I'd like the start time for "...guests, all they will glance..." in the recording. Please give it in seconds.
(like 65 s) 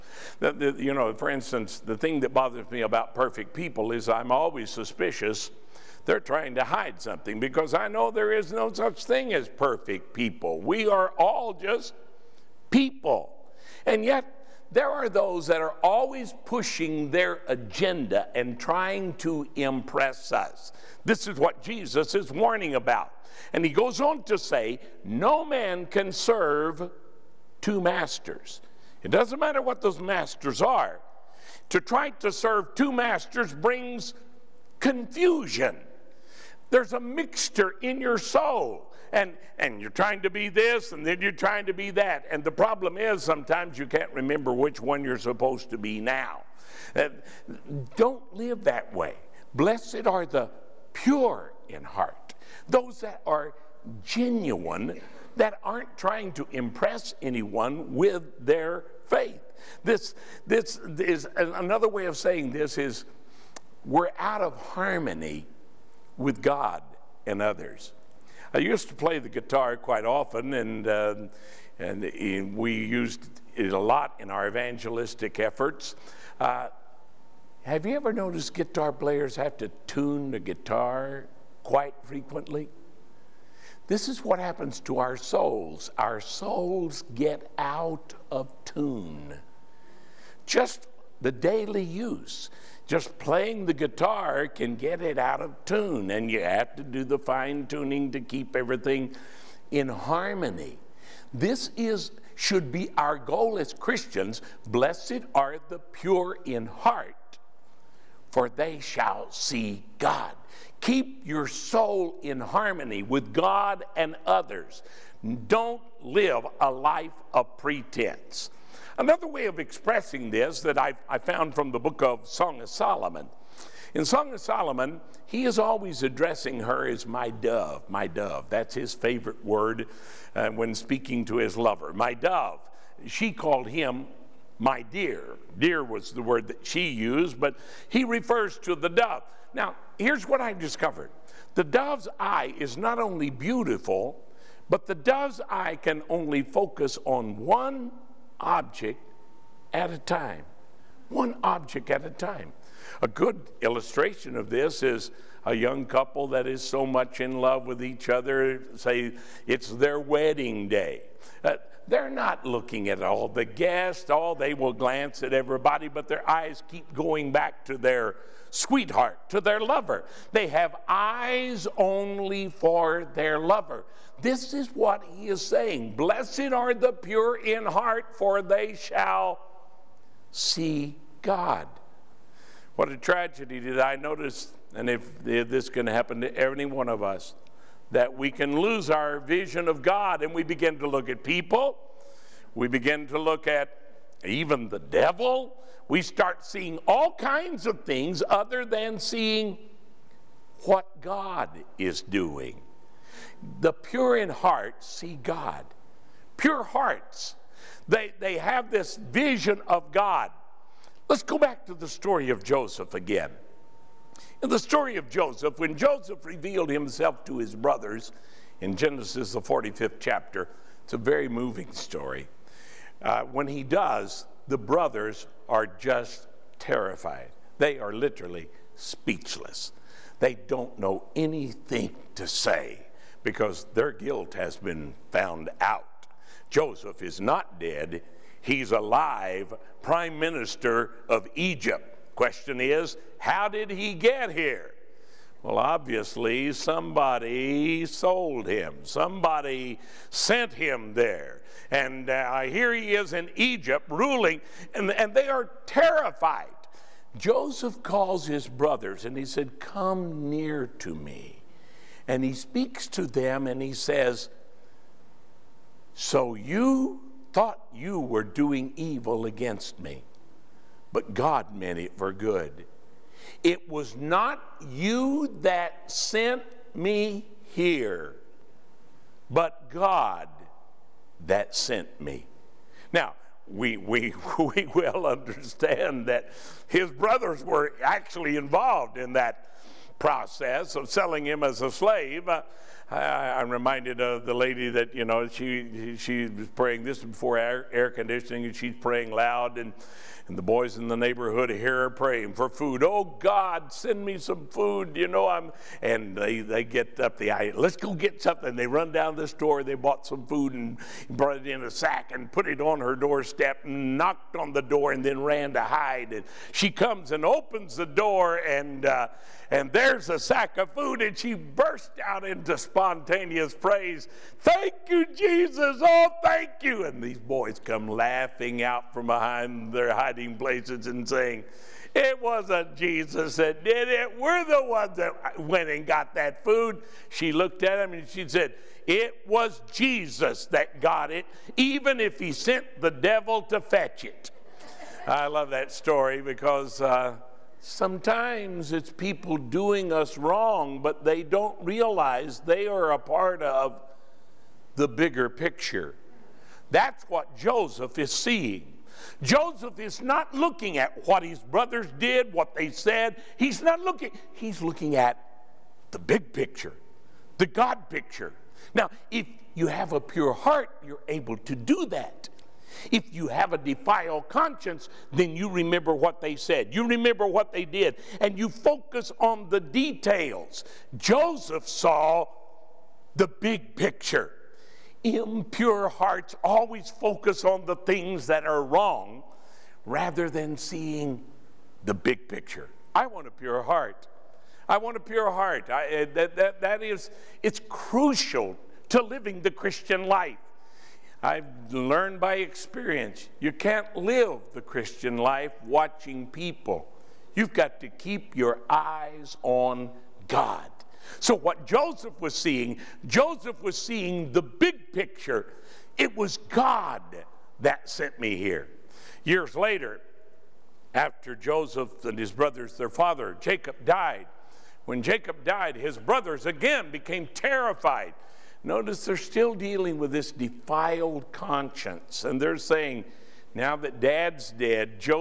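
163 s.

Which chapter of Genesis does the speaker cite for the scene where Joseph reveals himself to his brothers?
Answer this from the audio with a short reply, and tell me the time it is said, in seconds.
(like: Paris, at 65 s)
45th, at 219 s.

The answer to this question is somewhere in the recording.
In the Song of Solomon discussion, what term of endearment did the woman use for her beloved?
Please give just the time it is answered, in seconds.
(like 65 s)
134 s.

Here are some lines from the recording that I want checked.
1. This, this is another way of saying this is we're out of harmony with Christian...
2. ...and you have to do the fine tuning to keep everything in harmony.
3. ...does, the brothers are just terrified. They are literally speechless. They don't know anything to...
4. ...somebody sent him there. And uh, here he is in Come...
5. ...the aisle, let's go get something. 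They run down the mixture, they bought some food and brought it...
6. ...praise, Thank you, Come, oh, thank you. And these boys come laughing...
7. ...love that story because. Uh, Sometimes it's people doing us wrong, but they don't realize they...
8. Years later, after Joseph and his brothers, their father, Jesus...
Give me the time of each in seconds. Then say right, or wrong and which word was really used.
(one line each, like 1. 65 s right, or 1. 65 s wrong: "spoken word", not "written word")
1. 59 s wrong: "God", not "Christian"
2. 96 s right
3. 223 s right
4. 248 s wrong: "Egypt", not "Come"
5. 307 s wrong: "store", not "mixture"
6. 323 s wrong: "Jesus", not "Come"
7. 345 s right
8. 419 s wrong: "Jacob", not "Jesus".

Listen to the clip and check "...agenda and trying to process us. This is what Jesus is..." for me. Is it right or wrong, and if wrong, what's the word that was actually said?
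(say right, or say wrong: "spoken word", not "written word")
wrong: "impress", not "process".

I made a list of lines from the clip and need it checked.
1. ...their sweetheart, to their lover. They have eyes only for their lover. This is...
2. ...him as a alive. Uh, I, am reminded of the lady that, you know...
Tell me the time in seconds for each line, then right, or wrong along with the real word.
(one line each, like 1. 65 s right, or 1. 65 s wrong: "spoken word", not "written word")
1. 167 s right
2. 291 s wrong: "slave", not "alive".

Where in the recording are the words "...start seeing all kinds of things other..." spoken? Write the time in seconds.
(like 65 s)
196 s.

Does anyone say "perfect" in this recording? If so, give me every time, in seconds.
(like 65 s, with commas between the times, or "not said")
3 s, 9 s.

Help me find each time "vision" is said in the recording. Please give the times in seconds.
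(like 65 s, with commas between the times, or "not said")
189 s, 208 s.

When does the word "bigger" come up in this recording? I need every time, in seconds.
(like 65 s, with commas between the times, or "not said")
354 s.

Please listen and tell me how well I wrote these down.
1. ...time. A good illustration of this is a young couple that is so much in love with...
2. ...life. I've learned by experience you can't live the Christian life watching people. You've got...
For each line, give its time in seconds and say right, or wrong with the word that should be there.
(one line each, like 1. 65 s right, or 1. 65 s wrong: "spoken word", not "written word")
1. 152 s right
2. 400 s right.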